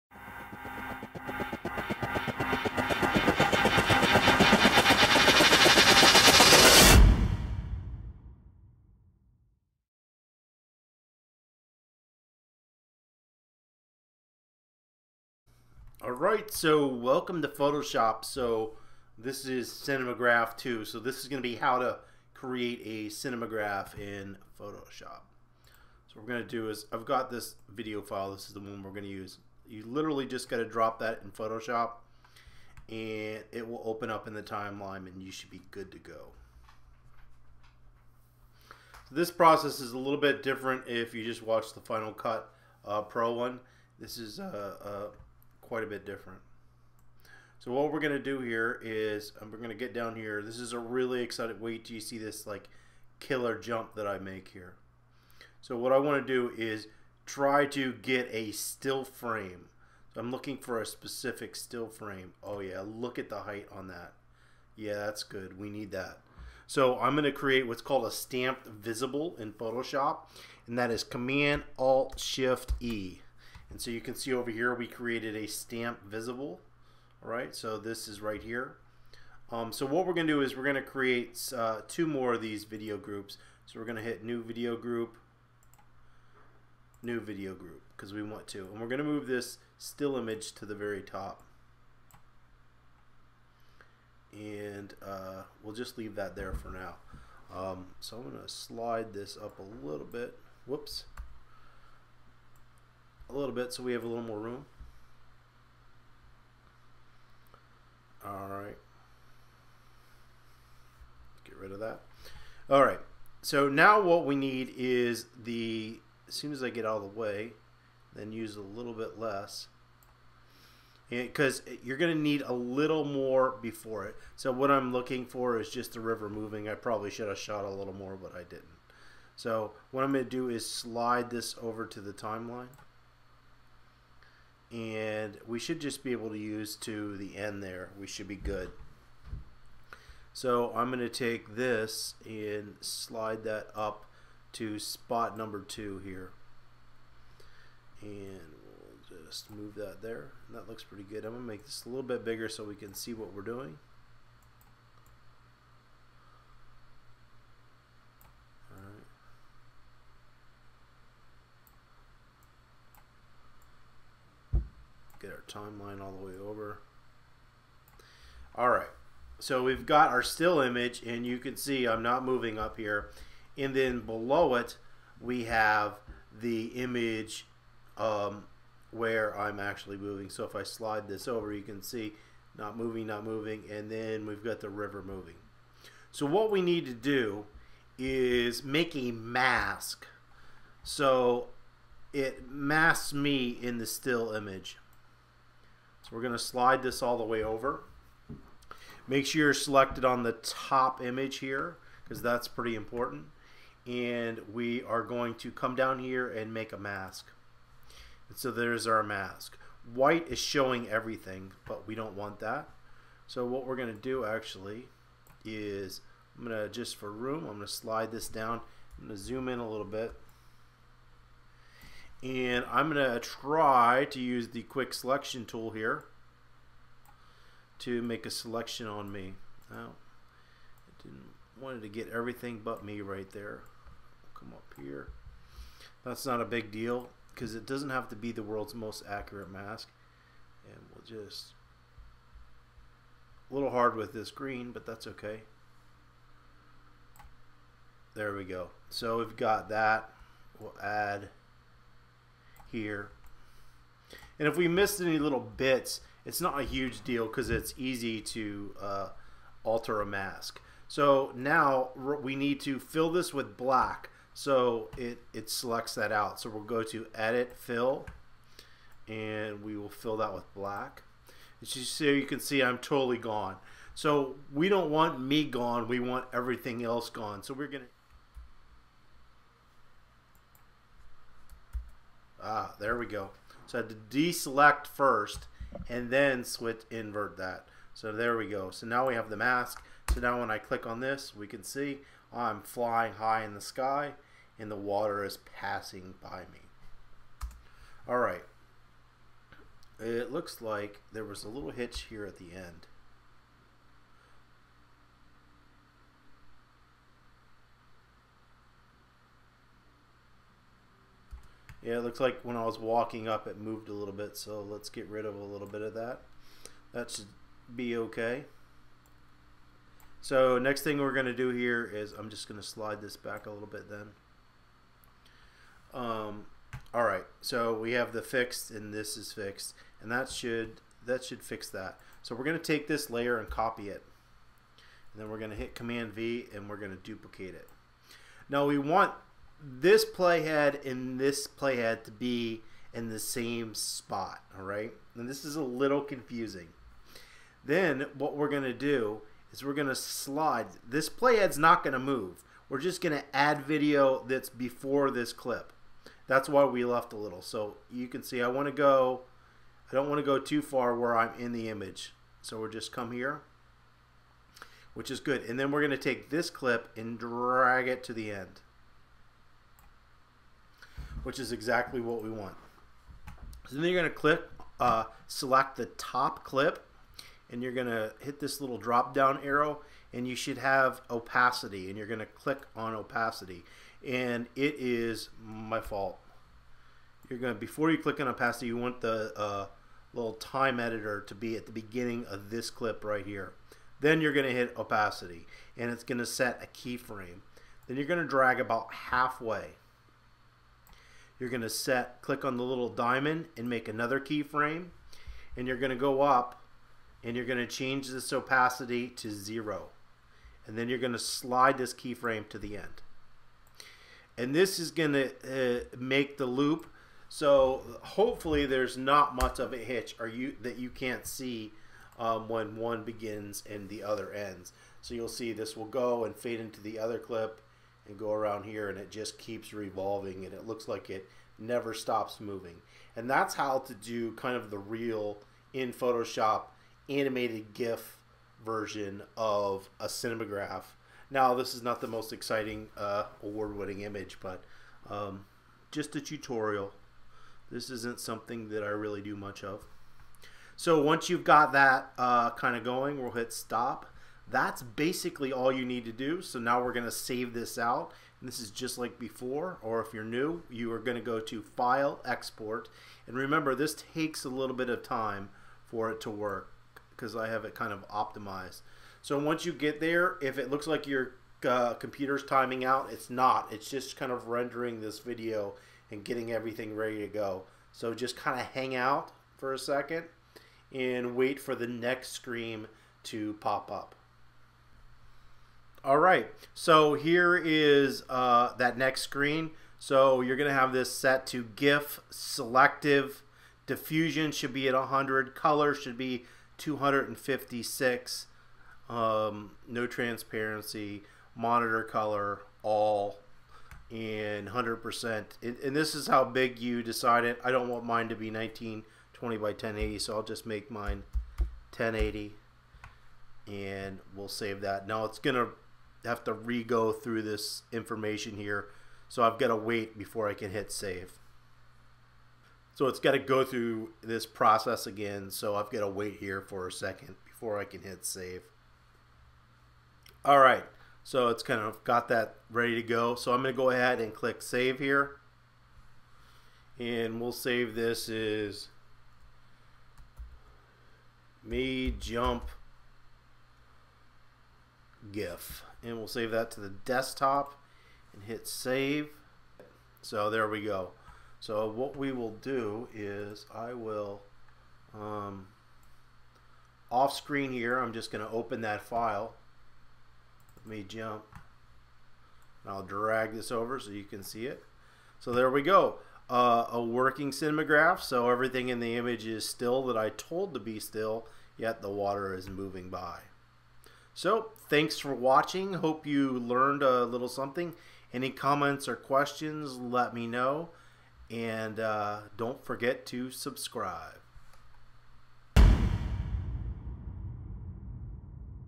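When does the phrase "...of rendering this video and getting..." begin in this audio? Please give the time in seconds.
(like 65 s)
474 s.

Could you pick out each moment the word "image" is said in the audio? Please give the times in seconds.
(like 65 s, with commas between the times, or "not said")
90 s, 170 s, 176 s, 194 s, 201 s, 361 s, 444 s, 569 s.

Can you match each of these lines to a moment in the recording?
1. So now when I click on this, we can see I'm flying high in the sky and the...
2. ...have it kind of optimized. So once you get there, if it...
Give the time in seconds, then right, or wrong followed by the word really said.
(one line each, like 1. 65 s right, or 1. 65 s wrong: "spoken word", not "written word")
1. 290 s right
2. 467 s right.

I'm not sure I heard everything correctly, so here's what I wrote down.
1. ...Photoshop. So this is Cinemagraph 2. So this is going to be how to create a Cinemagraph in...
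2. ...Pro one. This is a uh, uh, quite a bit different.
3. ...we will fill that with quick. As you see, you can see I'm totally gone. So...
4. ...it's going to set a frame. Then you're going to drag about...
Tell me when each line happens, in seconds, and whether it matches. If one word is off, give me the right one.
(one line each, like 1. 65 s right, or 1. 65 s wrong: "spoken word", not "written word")
1. 17 s right
2. 43 s right
3. 269 s wrong: "black", not "quick"
4. 395 s wrong: "keyframe", not "frame".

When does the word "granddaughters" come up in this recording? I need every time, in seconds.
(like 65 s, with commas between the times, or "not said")
not said.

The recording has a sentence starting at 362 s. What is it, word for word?
So we'll just come here, which is good.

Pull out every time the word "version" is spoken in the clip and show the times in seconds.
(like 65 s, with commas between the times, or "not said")
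438 s.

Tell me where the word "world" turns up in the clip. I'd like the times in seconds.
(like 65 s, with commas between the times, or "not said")
238 s.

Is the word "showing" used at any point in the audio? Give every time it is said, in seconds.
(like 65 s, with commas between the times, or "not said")
210 s.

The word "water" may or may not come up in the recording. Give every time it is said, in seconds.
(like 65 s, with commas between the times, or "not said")
294 s, 572 s.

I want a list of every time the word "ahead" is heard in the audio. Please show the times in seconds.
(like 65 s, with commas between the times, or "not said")
533 s.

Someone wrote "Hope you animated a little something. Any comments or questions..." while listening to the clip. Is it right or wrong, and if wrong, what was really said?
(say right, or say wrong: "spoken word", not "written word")
wrong: "learned", not "animated".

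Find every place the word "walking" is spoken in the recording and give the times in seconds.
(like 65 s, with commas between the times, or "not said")
312 s.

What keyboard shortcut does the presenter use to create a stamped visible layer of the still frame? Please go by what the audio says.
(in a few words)
Command Alt Shift E.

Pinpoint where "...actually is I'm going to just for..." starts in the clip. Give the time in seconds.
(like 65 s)
214 s.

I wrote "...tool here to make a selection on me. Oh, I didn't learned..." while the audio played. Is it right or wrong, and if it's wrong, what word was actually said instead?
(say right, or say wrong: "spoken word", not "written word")
wrong: "wanted", not "learned".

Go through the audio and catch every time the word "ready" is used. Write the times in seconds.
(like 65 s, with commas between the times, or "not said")
476 s, 532 s.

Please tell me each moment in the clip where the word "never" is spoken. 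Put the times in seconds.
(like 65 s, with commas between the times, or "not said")
431 s.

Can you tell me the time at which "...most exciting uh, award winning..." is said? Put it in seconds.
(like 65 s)
442 s.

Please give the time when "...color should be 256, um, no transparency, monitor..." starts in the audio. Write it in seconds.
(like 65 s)
495 s.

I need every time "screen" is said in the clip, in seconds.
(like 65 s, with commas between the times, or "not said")
482 s, 489 s, 557 s.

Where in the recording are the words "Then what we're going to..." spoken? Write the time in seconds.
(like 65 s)
347 s.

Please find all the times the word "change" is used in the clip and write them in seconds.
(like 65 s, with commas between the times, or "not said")
407 s.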